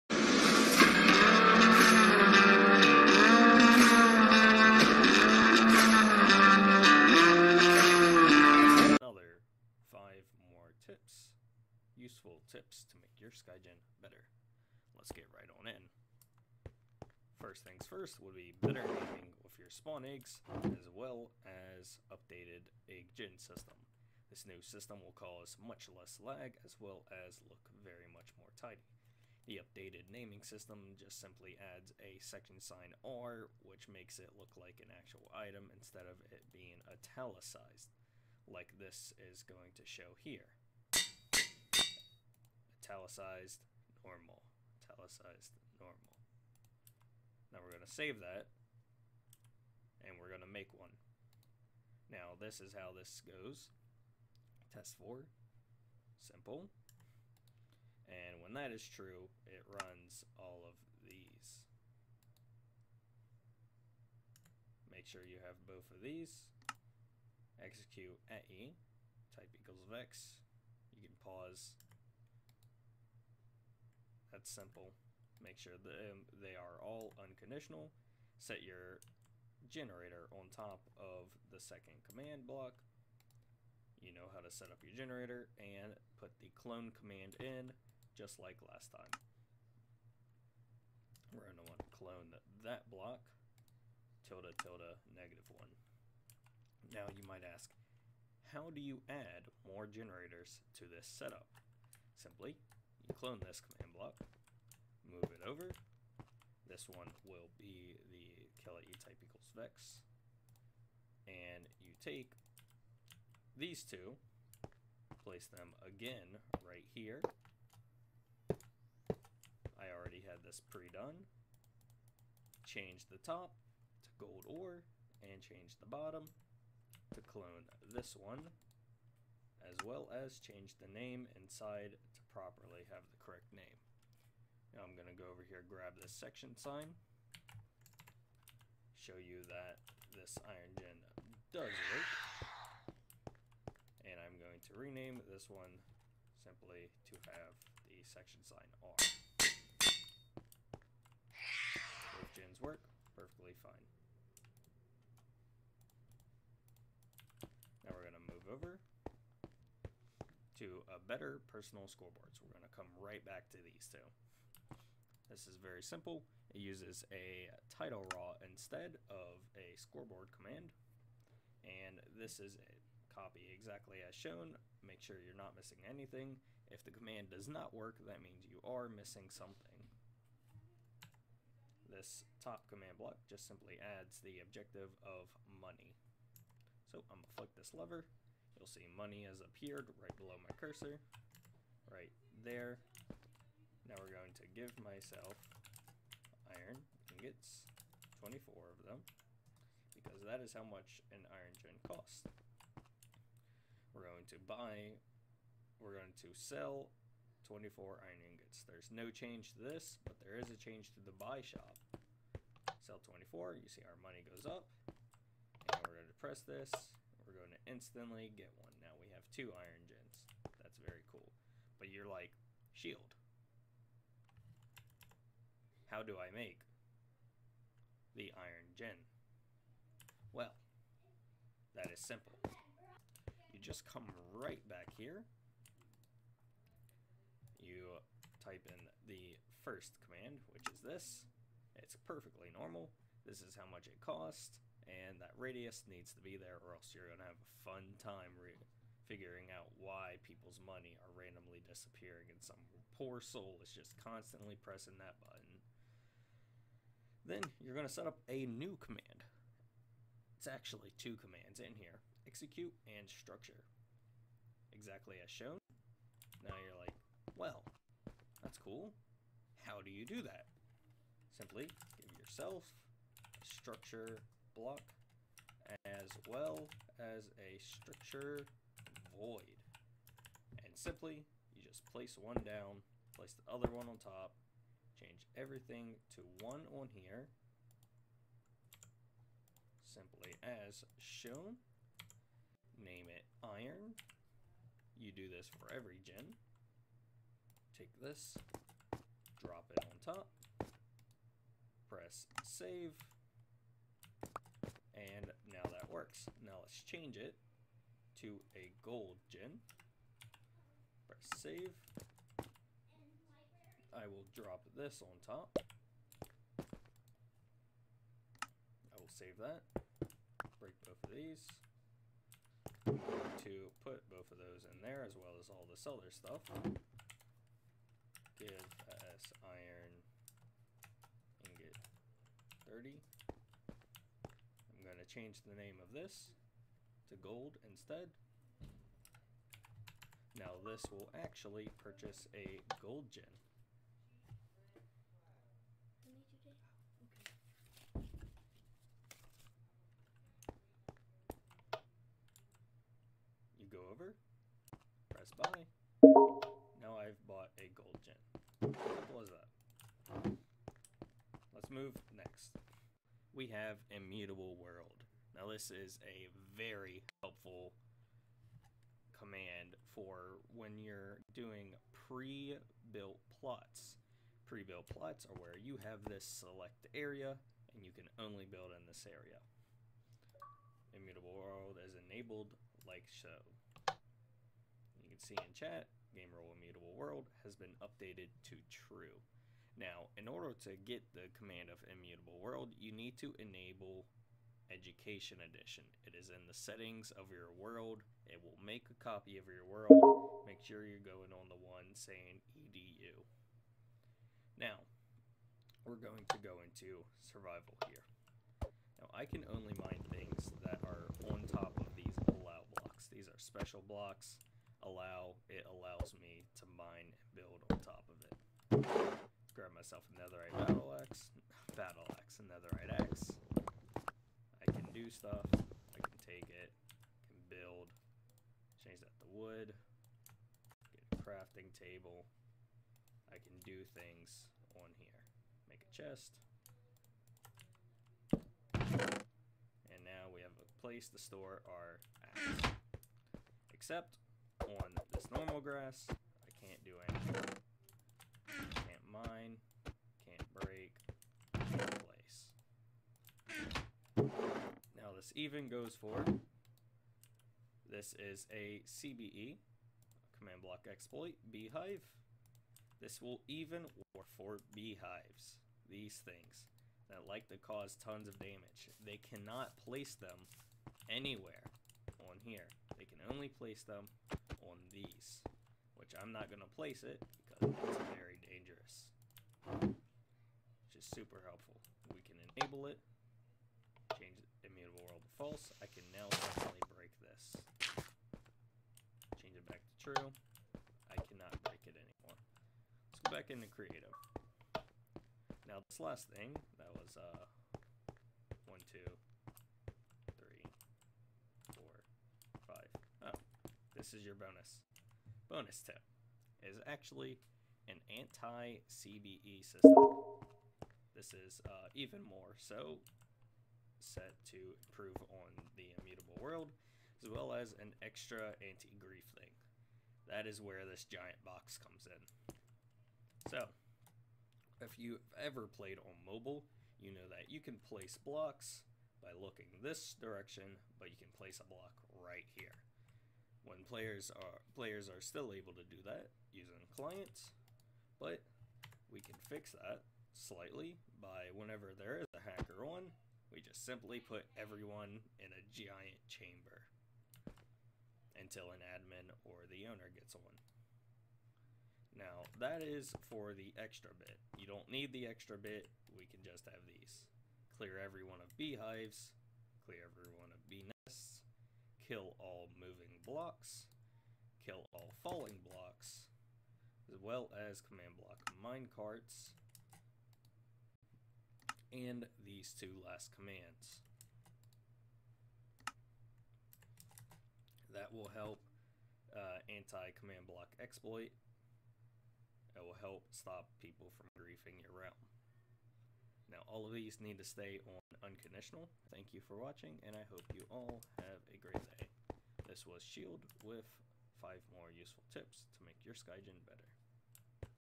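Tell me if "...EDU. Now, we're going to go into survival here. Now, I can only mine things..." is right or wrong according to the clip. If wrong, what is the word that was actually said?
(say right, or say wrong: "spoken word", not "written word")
right.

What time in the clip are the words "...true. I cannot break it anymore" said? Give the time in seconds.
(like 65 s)
490 s.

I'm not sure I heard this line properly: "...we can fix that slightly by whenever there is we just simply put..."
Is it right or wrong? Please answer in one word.
right.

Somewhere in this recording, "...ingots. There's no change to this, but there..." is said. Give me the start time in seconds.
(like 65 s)
208 s.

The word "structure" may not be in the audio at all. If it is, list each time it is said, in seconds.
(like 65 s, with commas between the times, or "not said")
263 s, 273 s, 277 s.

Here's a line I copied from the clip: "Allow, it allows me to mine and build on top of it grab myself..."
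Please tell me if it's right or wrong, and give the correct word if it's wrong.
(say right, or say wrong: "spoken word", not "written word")
right.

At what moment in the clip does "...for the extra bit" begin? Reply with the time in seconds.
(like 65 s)
553 s.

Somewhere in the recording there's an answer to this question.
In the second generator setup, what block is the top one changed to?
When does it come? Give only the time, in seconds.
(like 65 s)
124 s.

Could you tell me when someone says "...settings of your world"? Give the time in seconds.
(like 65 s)
396 s.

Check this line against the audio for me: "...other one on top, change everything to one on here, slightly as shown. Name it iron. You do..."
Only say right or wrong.
wrong.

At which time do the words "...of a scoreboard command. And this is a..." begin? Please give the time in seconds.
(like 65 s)
169 s.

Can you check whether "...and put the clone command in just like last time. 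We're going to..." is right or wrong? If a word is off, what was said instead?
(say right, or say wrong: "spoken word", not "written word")
right.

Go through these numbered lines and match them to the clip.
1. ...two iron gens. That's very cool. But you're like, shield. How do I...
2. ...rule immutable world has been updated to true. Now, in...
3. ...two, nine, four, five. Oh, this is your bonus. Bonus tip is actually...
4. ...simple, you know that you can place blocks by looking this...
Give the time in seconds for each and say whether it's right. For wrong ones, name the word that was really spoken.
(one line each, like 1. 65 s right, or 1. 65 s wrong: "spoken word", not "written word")
1. 219 s right
2. 386 s right
3. 498 s wrong: "three", not "nine"
4. 526 s wrong: "mobile", not "simple".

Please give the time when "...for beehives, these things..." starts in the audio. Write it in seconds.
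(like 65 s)
464 s.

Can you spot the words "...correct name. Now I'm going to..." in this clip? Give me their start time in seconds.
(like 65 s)
133 s.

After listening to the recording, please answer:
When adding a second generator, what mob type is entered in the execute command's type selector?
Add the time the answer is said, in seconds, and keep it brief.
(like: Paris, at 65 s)
vex, at 109 s.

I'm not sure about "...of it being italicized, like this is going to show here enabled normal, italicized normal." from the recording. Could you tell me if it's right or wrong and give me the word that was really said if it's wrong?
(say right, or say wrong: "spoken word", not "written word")
wrong: "italicized", not "enabled".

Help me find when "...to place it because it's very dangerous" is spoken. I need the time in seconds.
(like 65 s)
476 s.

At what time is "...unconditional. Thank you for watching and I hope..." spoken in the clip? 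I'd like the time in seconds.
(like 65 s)
588 s.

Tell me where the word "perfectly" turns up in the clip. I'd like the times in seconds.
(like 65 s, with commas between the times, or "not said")
153 s, 242 s.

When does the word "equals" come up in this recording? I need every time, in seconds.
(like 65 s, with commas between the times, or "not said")
69 s, 109 s.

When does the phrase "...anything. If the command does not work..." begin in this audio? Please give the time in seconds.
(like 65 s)
175 s.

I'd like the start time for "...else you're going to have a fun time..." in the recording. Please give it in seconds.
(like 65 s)
246 s.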